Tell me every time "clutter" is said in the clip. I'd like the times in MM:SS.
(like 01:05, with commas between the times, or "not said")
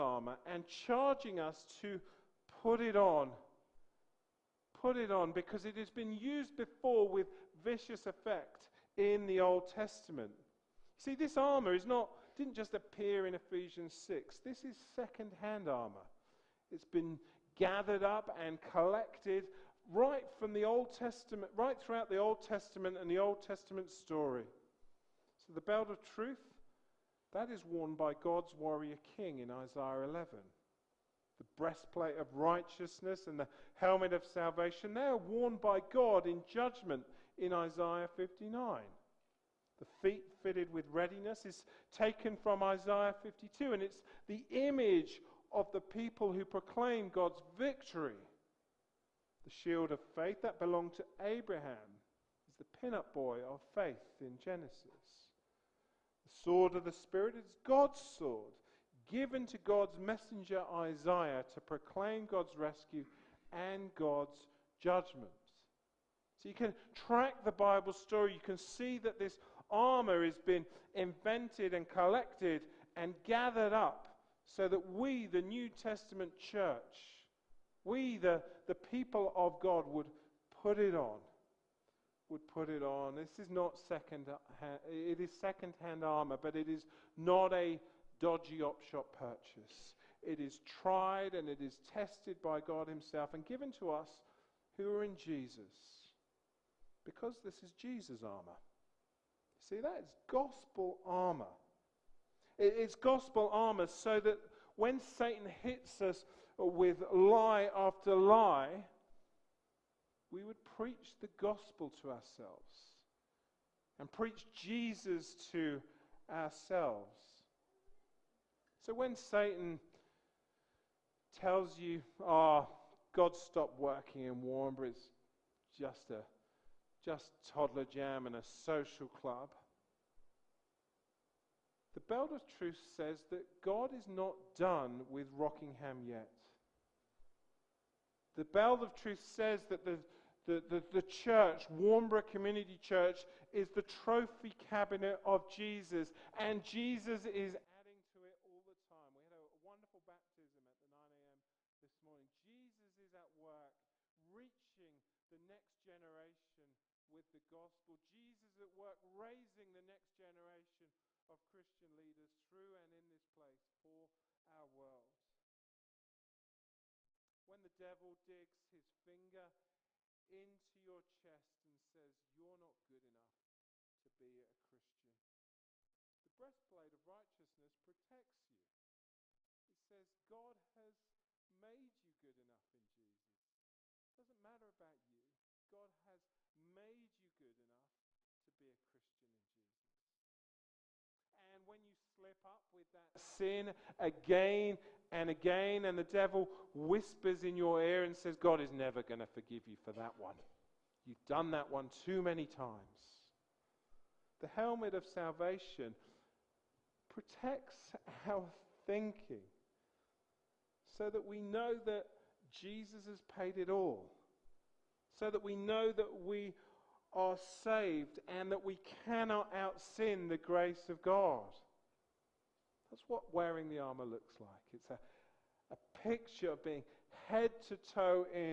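not said.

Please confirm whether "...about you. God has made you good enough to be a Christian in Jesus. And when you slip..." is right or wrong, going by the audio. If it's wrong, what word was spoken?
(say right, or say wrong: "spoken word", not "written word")
right.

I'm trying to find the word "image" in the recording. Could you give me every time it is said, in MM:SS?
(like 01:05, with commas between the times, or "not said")
00:44.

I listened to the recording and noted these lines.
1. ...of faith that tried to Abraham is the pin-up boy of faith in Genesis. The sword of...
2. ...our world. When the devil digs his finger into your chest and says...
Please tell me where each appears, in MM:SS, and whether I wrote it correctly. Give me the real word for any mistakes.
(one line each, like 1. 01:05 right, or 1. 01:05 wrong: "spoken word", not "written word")
1. 00:49 wrong: "belonged", not "tried"
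2. 02:44 right.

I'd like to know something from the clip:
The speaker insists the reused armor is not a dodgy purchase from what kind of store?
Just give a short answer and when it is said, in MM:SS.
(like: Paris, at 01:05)
op shop, at 01:28.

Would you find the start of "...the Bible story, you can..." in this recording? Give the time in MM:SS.
01:07.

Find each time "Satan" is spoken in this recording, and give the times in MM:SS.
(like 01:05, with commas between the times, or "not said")
01:44, 01:59.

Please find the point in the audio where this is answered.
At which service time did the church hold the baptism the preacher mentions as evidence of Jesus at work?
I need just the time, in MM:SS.
02:30.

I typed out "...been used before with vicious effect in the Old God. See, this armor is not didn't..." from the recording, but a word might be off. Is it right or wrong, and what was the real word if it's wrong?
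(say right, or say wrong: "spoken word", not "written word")
wrong: "Testament", not "God".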